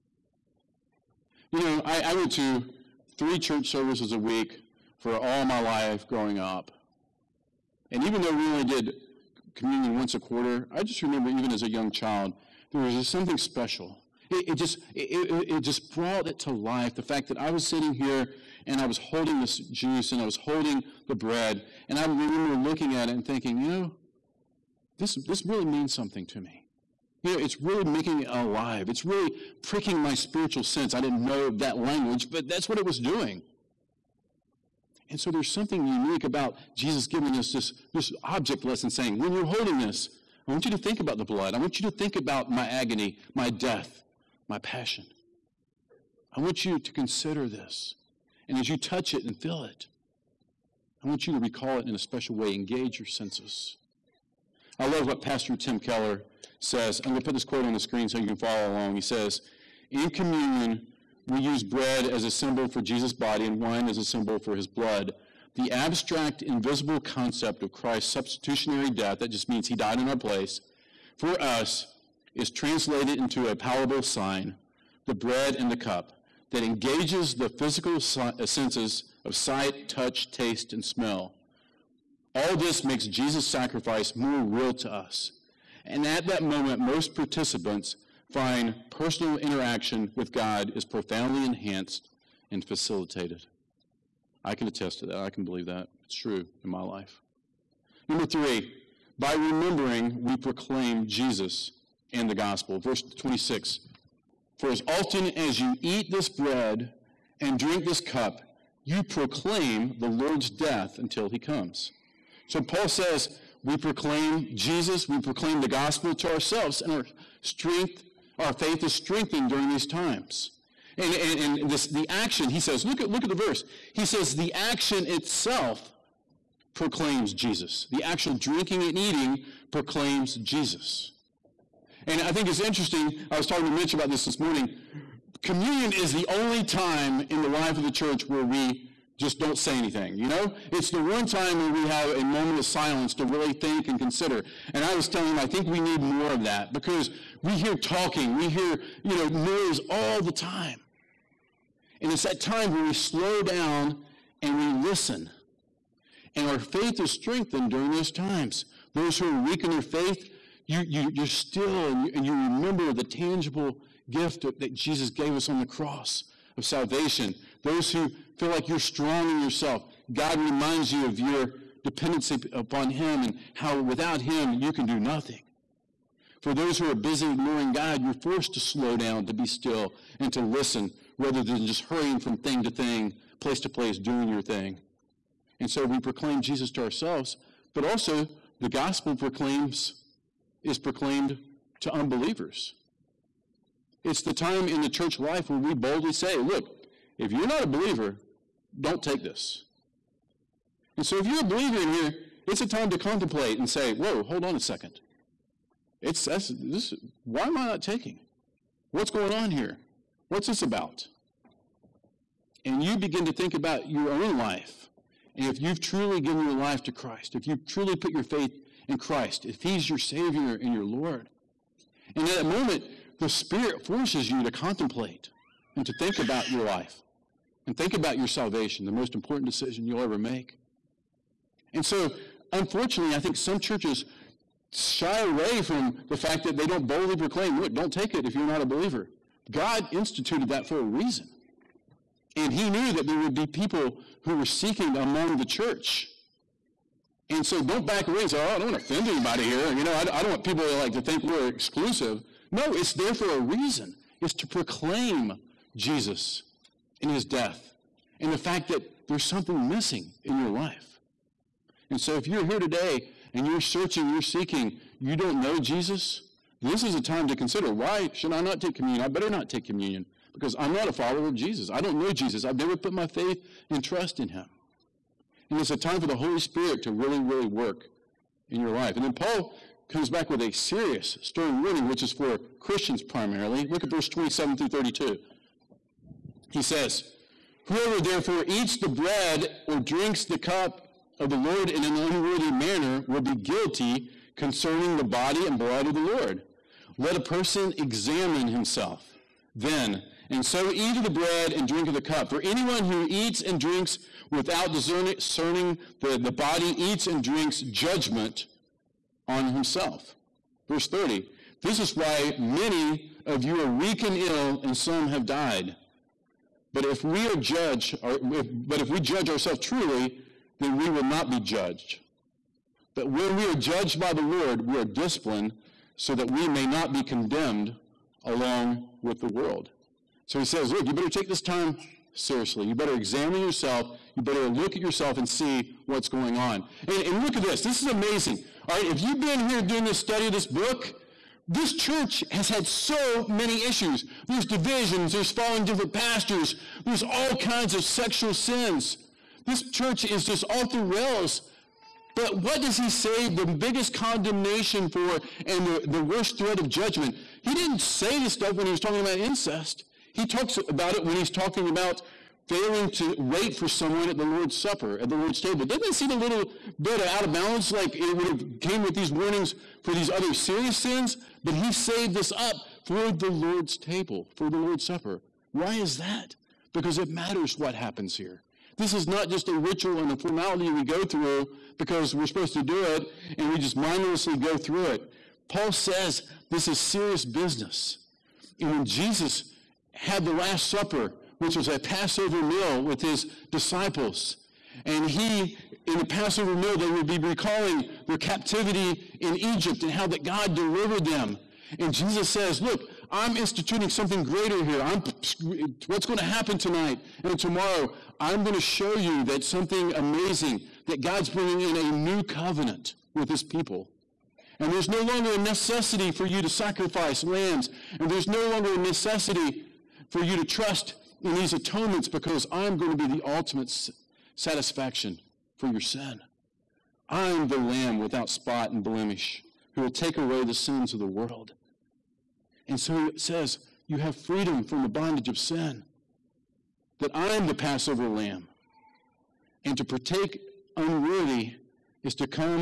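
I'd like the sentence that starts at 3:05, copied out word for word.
And so we proclaim Jesus to ourselves, but also the gospel proclaims is proclaimed to unbelievers.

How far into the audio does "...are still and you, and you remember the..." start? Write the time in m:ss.
2:41.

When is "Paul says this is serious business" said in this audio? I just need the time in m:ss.
6:25.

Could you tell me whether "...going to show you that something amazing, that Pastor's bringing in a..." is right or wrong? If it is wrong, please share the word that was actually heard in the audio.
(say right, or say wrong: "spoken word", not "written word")
wrong: "God", not "Pastor".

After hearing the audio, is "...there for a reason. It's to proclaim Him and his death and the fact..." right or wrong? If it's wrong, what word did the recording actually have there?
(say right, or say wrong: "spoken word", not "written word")
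wrong: "Jesus", not "Him".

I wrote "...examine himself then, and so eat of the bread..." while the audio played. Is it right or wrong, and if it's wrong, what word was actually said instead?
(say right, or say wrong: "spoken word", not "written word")
right.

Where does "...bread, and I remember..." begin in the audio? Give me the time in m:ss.
0:21.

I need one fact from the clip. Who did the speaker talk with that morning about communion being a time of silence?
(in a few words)
Mitch.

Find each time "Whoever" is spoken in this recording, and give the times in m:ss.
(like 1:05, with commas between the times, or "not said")
4:47.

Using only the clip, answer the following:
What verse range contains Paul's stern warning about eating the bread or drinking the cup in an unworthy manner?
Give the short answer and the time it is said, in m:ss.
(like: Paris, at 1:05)
27 through 32, at 4:44.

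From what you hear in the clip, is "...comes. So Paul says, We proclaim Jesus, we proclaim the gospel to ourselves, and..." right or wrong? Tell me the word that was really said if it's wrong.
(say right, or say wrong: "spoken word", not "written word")
right.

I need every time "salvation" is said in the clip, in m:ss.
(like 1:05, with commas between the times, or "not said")
2:46, 3:48.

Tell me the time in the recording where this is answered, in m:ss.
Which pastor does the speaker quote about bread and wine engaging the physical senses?
0:55.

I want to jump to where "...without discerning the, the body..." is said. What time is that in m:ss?
5:04.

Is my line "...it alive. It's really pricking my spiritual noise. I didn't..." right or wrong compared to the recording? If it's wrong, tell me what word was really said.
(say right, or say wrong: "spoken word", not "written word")
wrong: "sense", not "noise".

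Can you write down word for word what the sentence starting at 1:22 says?
All this makes Jesus' sacrifice more real to us.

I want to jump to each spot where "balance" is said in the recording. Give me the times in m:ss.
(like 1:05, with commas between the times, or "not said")
6:07.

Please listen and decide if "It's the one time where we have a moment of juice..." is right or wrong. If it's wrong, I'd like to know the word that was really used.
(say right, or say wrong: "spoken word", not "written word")
wrong: "silence", not "juice".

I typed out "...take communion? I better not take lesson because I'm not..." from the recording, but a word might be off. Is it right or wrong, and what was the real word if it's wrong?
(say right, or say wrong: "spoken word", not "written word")
wrong: "communion", not "lesson".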